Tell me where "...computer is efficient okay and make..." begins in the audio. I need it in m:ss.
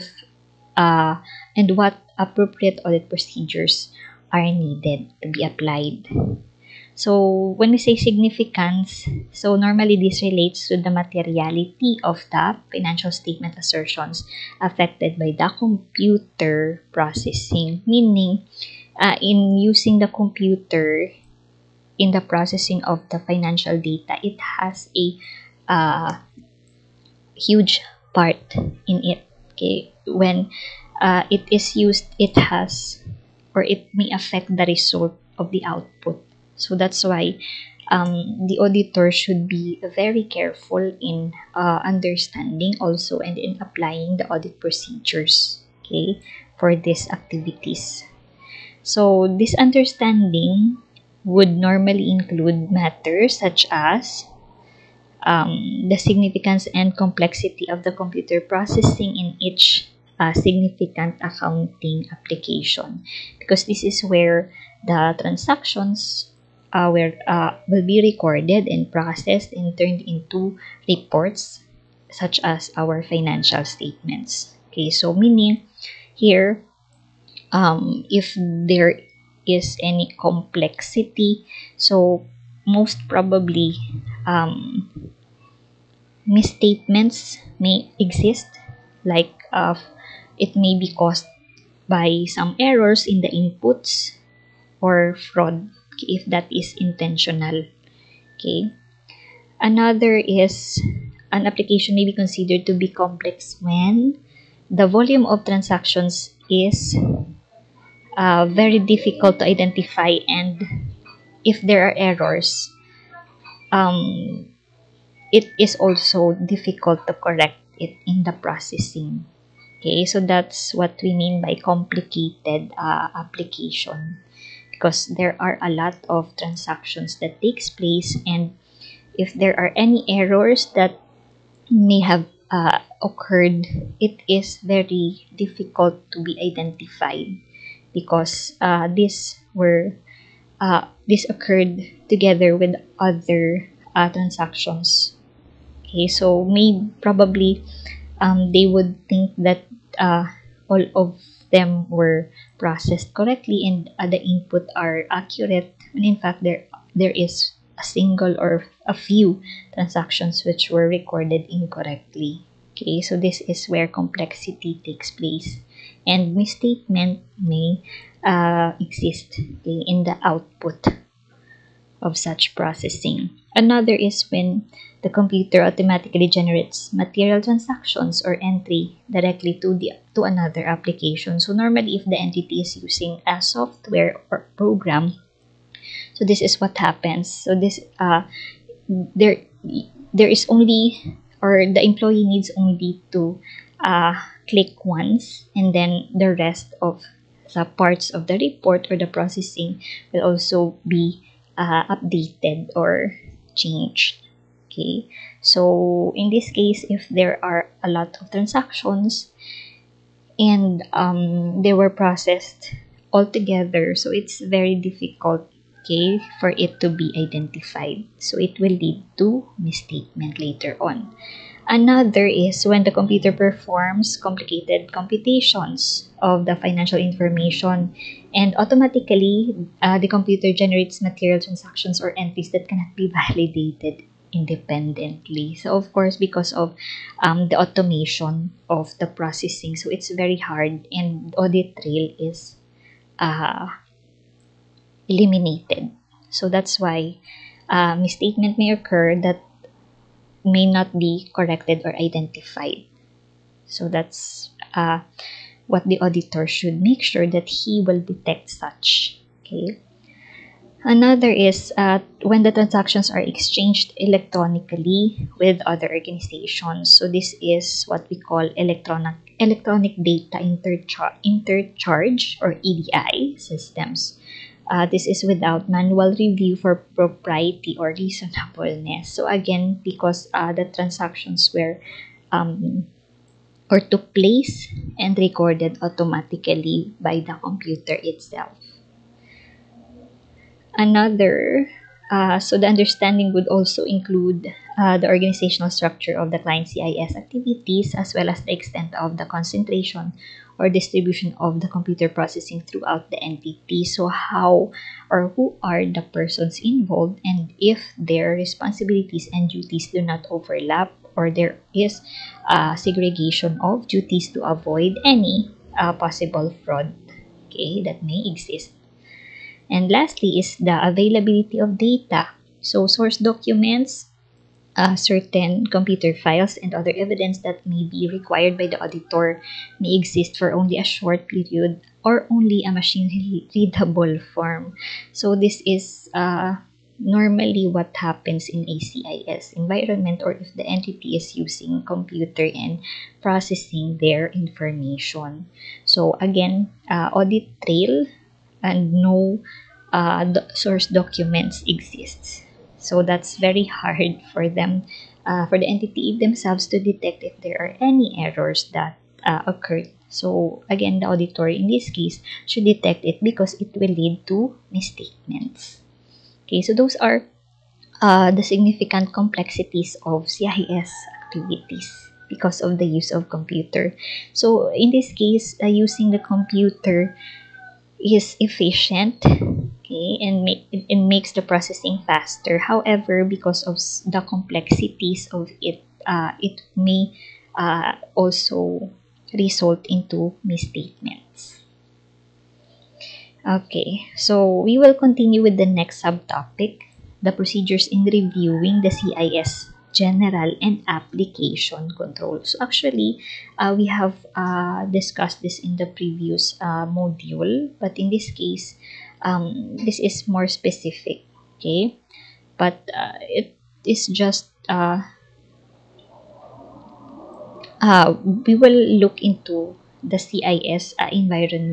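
6:16.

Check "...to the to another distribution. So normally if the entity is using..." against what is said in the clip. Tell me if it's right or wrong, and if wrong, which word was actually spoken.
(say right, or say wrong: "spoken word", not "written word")
wrong: "application", not "distribution".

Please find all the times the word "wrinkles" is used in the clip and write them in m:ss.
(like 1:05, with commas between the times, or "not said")
not said.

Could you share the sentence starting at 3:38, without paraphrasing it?
So it will lead to misstatement later on.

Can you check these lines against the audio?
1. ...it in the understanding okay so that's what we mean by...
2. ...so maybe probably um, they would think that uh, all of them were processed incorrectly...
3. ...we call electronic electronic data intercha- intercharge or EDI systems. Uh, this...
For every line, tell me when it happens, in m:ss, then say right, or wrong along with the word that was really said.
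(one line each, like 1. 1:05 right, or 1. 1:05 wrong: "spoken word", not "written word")
1. 1:57 wrong: "processing", not "understanding"
2. 2:26 wrong: "correctly", not "incorrectly"
3. 4:28 right.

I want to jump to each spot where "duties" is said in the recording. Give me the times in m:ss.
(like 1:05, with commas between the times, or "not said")
5:09, 5:13.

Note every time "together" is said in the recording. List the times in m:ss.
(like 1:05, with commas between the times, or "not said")
2:22, 3:33.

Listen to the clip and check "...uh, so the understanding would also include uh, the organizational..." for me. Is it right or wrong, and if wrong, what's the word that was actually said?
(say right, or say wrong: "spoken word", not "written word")
right.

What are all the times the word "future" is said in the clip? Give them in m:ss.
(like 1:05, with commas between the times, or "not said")
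not said.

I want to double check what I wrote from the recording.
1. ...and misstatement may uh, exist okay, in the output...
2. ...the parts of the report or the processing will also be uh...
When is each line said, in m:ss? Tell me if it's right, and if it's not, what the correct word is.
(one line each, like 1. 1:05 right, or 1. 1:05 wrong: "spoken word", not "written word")
1. 2:46 right
2. 3:17 right.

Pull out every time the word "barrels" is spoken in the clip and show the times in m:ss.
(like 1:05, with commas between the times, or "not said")
not said.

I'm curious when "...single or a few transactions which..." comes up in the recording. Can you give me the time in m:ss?
2:37.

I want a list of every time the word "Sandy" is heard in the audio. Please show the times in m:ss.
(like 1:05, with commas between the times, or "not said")
not said.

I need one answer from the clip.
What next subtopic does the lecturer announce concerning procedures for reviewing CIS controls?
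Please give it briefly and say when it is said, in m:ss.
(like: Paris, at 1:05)
general and application control, at 6:39.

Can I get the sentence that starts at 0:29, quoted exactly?
Okay, when uh, it is used, it has or it may affect the result of the output.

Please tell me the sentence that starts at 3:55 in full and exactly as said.
So of course, because of um, the automation of the processing, so it's very hard and audit trail is uh, eliminated.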